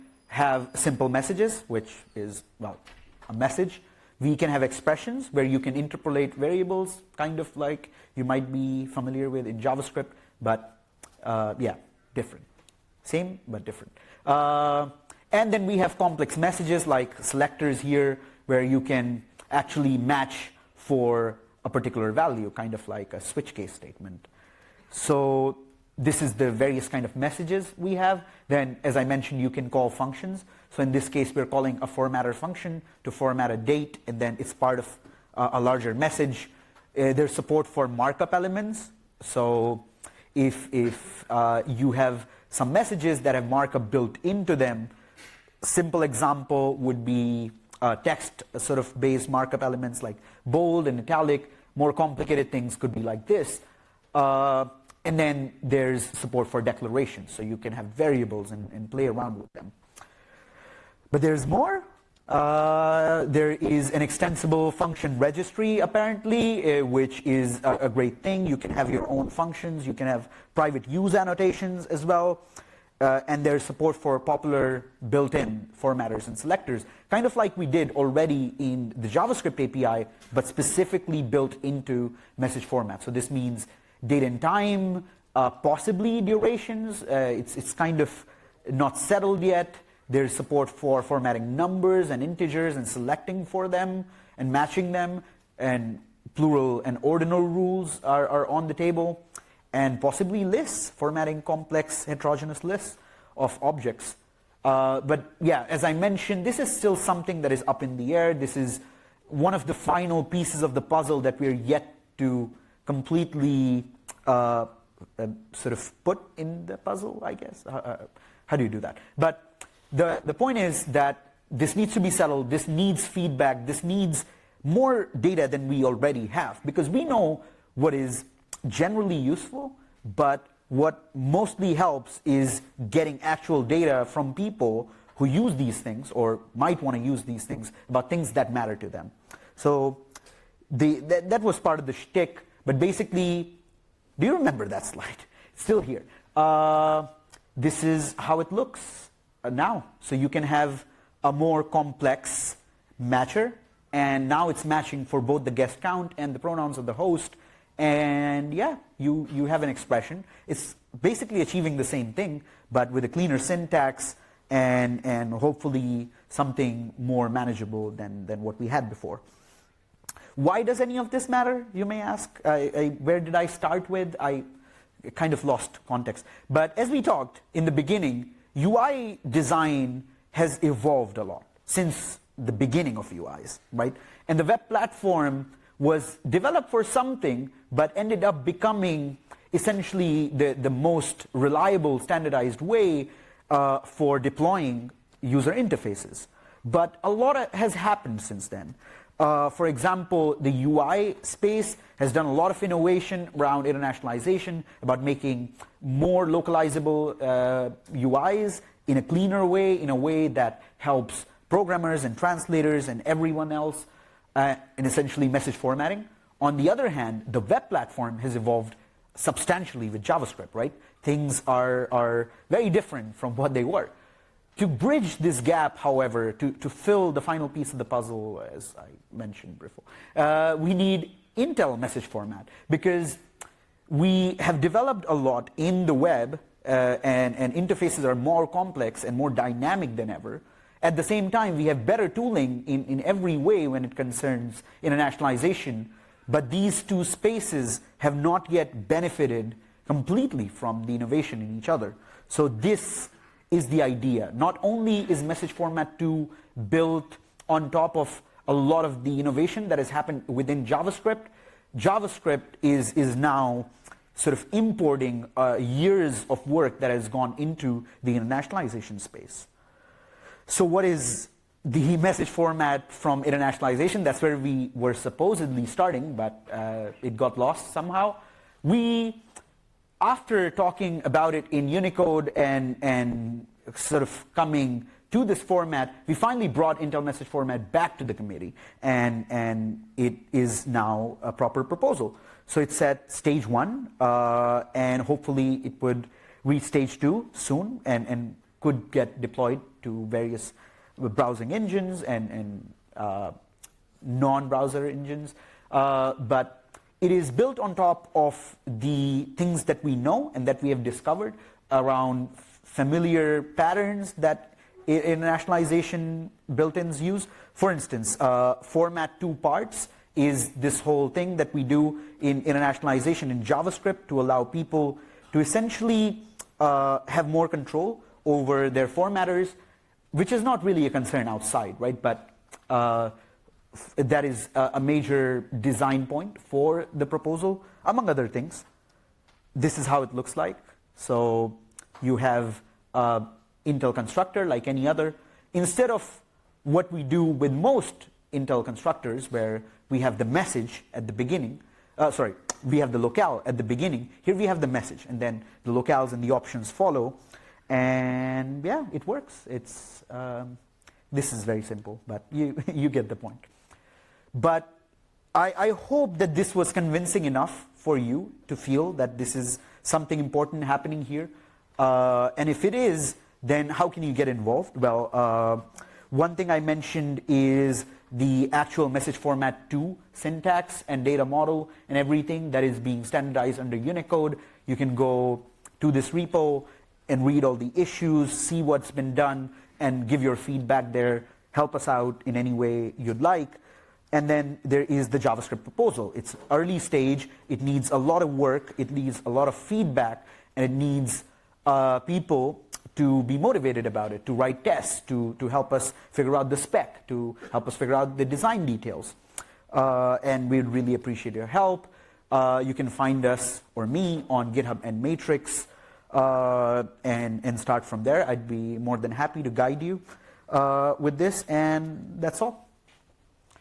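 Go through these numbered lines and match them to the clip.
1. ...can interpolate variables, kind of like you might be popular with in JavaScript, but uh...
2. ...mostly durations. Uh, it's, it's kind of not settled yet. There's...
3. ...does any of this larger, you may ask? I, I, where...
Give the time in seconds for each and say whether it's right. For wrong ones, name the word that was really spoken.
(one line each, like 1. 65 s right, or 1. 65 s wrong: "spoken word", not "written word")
1. 5 s wrong: "familiar", not "popular"
2. 85 s wrong: "possibly", not "mostly"
3. 170 s wrong: "matter", not "larger".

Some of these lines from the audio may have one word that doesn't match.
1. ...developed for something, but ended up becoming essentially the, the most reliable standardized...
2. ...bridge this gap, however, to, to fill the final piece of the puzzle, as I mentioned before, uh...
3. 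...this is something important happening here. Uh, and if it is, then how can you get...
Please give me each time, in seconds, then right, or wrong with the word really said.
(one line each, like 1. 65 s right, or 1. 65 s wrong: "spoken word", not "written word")
1. 186 s right
2. 224 s right
3. 369 s right.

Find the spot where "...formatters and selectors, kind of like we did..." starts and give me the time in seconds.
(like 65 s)
75 s.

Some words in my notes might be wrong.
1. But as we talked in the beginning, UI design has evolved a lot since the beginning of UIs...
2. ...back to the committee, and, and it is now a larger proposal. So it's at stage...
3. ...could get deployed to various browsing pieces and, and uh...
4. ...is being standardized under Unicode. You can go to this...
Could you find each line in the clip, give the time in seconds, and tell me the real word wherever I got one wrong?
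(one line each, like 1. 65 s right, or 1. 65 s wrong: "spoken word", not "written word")
1. 176 s right
2. 287 s wrong: "proper", not "larger"
3. 298 s wrong: "engines", not "pieces"
4. 382 s right.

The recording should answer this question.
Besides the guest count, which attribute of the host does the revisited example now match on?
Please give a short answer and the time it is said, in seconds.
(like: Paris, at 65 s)
pronouns, at 156 s.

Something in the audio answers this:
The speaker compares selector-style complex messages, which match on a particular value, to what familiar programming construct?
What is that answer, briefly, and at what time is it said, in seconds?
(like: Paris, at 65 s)
switch case statement, at 23 s.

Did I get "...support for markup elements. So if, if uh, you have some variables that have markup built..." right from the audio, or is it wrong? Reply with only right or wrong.
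wrong.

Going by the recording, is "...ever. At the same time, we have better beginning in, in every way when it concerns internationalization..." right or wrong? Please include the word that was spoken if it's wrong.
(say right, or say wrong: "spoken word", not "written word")
wrong: "tooling", not "beginning".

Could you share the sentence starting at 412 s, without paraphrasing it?
Uh, you can find us, or me, on GitHub and Matrix, uh, and, and start from there.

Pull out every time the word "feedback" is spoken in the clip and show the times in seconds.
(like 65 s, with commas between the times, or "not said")
123 s, 390 s, 399 s.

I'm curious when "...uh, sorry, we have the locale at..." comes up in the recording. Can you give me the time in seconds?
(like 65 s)
351 s.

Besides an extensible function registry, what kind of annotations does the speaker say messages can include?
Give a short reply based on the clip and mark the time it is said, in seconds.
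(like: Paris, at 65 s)
private use annotations, at 70 s.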